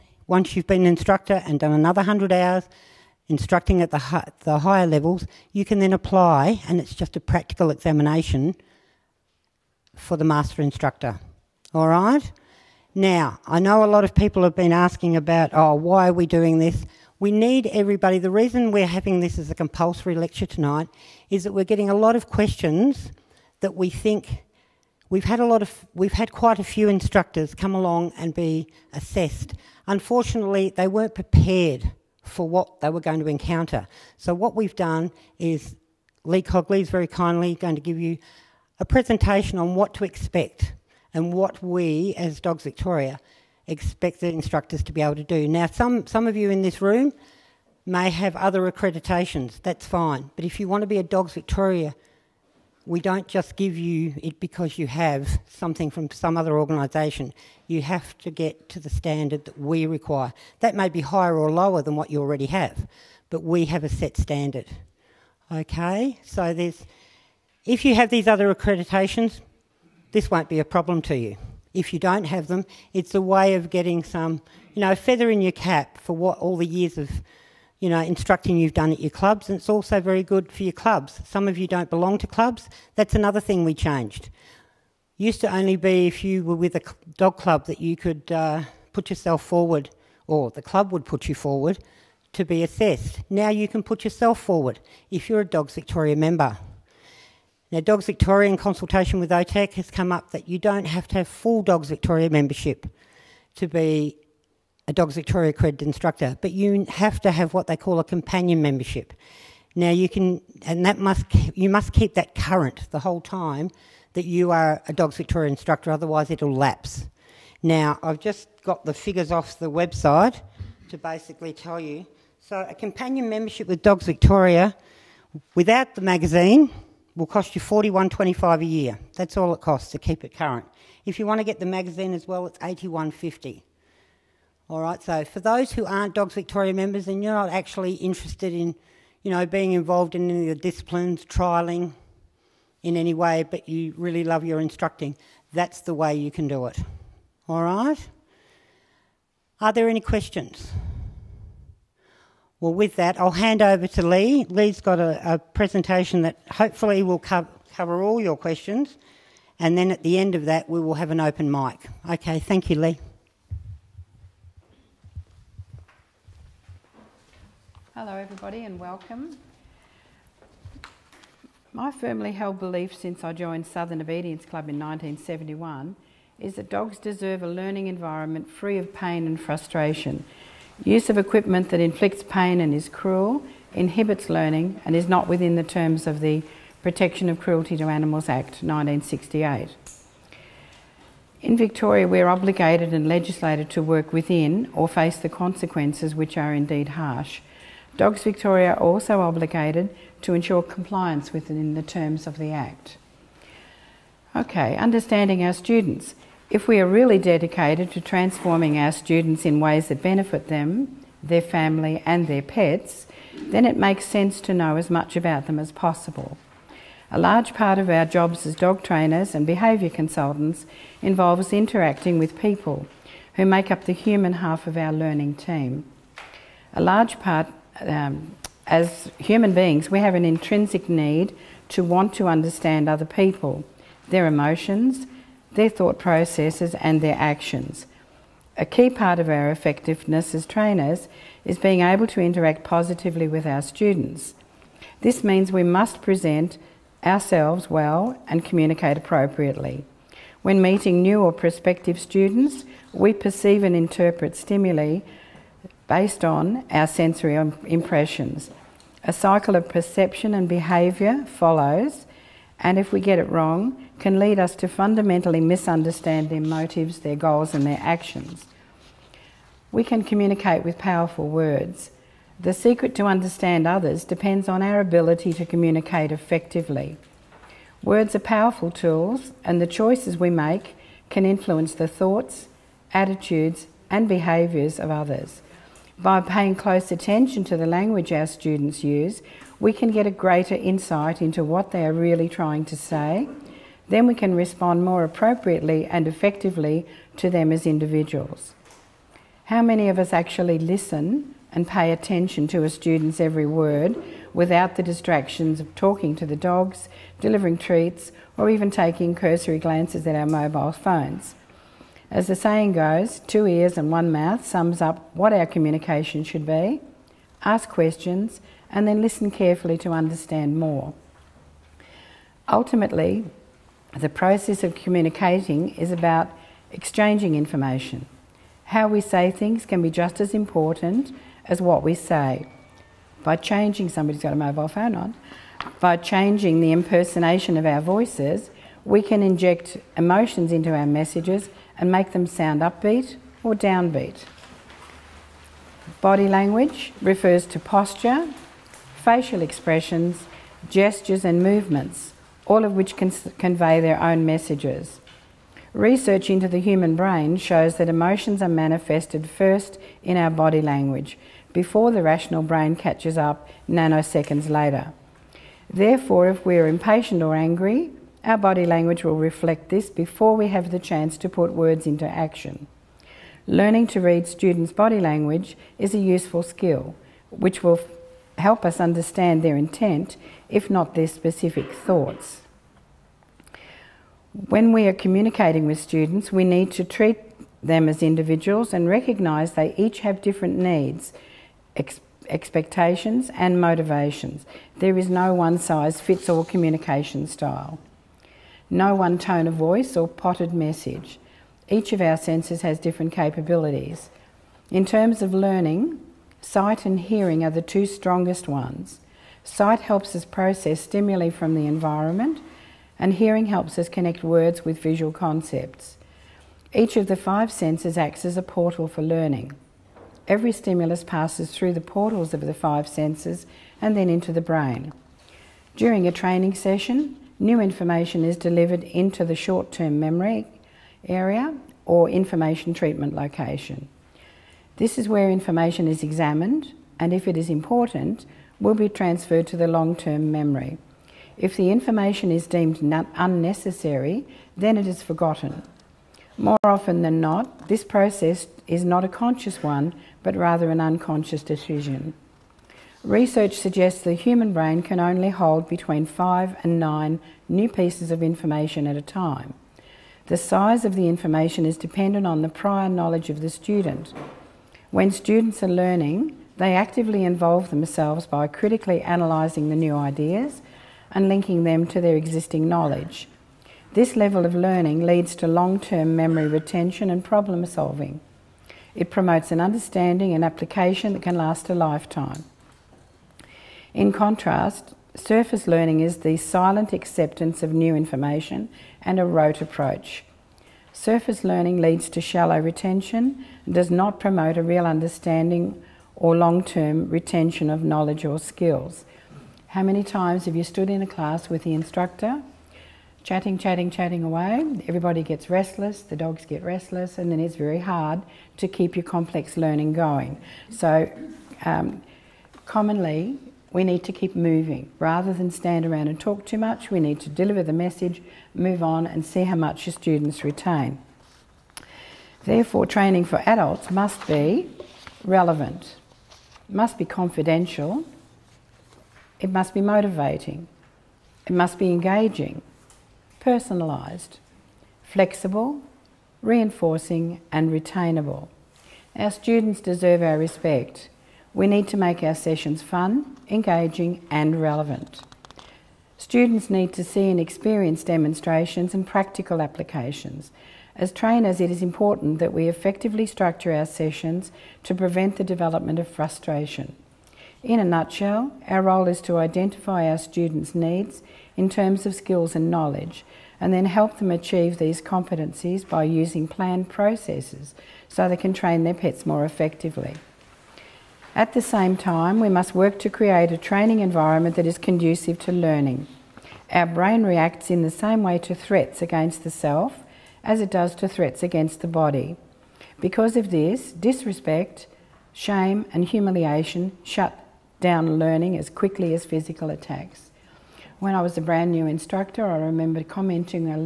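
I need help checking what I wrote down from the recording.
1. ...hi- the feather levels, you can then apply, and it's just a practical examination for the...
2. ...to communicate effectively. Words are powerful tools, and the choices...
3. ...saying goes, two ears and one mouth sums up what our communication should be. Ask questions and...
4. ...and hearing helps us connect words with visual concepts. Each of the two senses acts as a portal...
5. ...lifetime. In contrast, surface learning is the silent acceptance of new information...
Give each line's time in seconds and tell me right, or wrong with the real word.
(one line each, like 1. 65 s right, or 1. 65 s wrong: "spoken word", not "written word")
1. 3 s wrong: "higher", not "feather"
2. 275 s right
3. 312 s right
4. 412 s wrong: "five", not "two"
5. 481 s right.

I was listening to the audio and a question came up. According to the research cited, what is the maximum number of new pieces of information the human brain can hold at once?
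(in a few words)
9.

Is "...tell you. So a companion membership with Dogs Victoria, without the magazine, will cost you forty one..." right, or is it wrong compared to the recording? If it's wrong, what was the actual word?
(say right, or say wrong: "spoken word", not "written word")
right.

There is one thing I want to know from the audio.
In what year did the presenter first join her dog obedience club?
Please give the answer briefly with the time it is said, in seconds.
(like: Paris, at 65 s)
1971, at 174 s.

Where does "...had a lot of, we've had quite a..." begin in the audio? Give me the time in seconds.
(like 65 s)
25 s.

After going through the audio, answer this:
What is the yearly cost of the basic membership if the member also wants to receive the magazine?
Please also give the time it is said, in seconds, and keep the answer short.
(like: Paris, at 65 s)
$81.50, at 132 s.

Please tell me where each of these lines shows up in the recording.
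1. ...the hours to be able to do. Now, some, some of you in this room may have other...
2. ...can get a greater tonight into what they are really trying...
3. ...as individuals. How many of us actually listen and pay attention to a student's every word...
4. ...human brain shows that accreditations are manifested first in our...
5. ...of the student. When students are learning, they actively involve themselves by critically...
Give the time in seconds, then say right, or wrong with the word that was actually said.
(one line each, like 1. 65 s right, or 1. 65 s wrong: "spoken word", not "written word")
1. 44 s wrong: "instructors", not "hours"
2. 289 s wrong: "insight", not "tonight"
3. 297 s right
4. 356 s wrong: "emotions", not "accreditations"
5. 463 s right.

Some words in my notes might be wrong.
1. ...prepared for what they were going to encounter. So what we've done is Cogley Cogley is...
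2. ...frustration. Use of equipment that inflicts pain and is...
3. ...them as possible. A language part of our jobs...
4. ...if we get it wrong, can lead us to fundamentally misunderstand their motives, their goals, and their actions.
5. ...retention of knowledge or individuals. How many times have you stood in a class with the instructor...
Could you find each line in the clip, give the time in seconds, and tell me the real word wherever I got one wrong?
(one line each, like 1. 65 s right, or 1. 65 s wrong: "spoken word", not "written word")
1. 31 s wrong: "Lee", not "Cogley"
2. 179 s right
3. 215 s wrong: "large", not "language"
4. 262 s right
5. 497 s wrong: "skills", not "individuals".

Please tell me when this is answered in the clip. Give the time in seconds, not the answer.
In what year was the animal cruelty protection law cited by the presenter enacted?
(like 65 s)
188 s.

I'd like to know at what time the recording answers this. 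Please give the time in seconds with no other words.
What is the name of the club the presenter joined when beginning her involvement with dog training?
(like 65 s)
173 s.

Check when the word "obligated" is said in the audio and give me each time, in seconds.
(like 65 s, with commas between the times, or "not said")
192 s, 199 s.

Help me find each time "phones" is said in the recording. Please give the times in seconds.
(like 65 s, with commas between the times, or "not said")
310 s, 334 s.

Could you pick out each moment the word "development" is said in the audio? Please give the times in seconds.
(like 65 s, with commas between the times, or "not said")
555 s.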